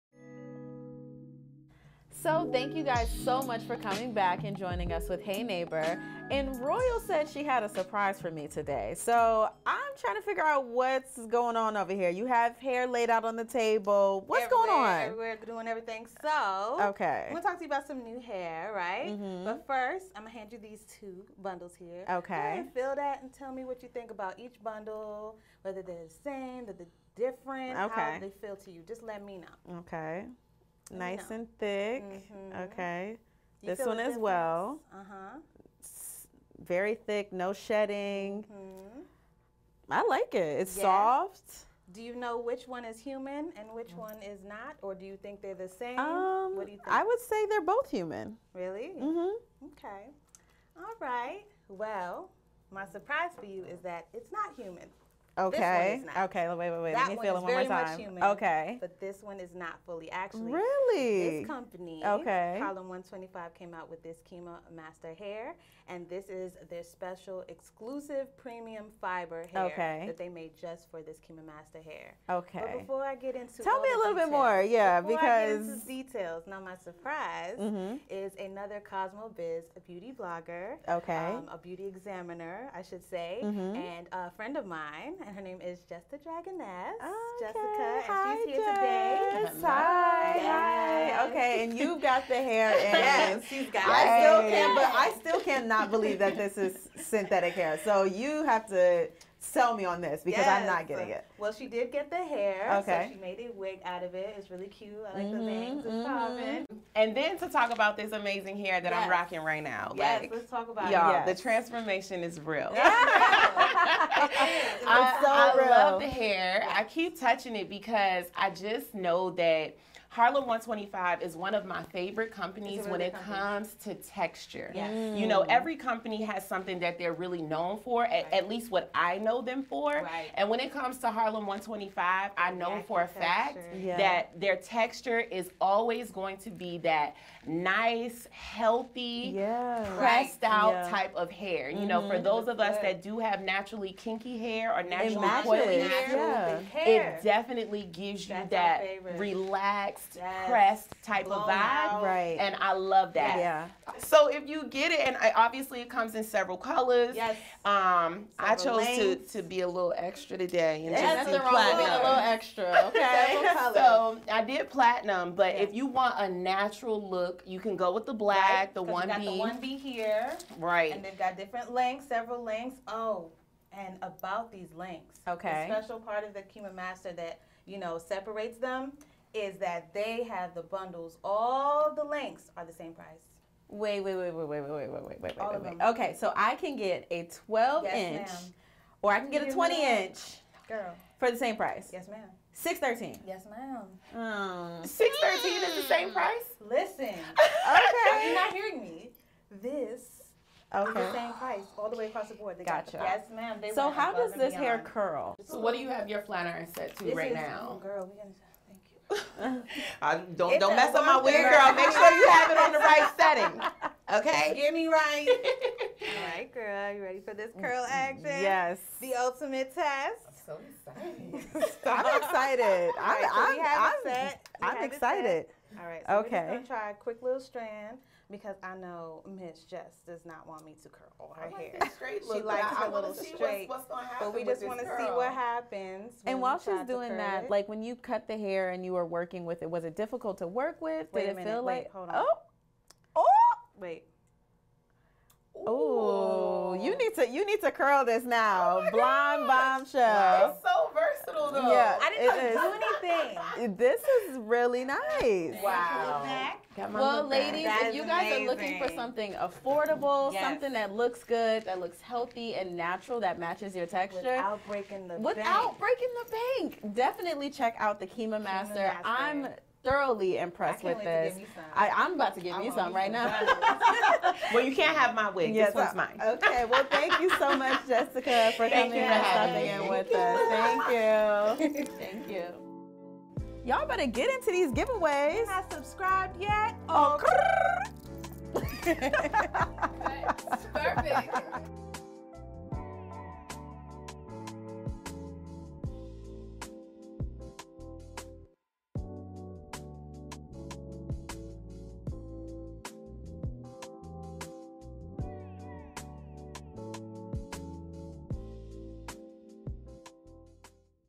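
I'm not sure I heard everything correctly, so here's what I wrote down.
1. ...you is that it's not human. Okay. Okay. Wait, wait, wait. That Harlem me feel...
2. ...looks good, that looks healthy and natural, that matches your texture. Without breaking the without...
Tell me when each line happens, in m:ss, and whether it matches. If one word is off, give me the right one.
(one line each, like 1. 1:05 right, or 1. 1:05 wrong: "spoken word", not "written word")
1. 0:53 wrong: "Let", not "Harlem"
2. 4:20 right.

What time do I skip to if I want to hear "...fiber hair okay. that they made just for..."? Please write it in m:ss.
1:08.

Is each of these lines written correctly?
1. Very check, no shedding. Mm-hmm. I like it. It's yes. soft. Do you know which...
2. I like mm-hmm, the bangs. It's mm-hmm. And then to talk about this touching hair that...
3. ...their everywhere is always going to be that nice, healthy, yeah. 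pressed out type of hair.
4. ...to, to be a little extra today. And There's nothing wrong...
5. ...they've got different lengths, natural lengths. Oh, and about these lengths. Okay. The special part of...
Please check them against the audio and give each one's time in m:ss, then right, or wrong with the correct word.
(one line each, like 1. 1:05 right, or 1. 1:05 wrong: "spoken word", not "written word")
1. 0:36 wrong: "thick", not "check"
2. 1:45 wrong: "amazing", not "touching"
3. 2:14 wrong: "texture", not "everywhere"
4. 2:38 right
5. 2:51 wrong: "several", not "natural".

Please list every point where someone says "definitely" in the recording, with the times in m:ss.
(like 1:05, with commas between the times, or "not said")
2:27, 4:26.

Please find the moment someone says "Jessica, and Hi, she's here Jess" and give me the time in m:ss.
1:27.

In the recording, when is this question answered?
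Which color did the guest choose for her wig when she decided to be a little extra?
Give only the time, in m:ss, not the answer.
2:44.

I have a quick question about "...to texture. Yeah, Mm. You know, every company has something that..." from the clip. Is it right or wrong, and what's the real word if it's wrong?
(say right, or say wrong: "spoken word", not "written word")
right.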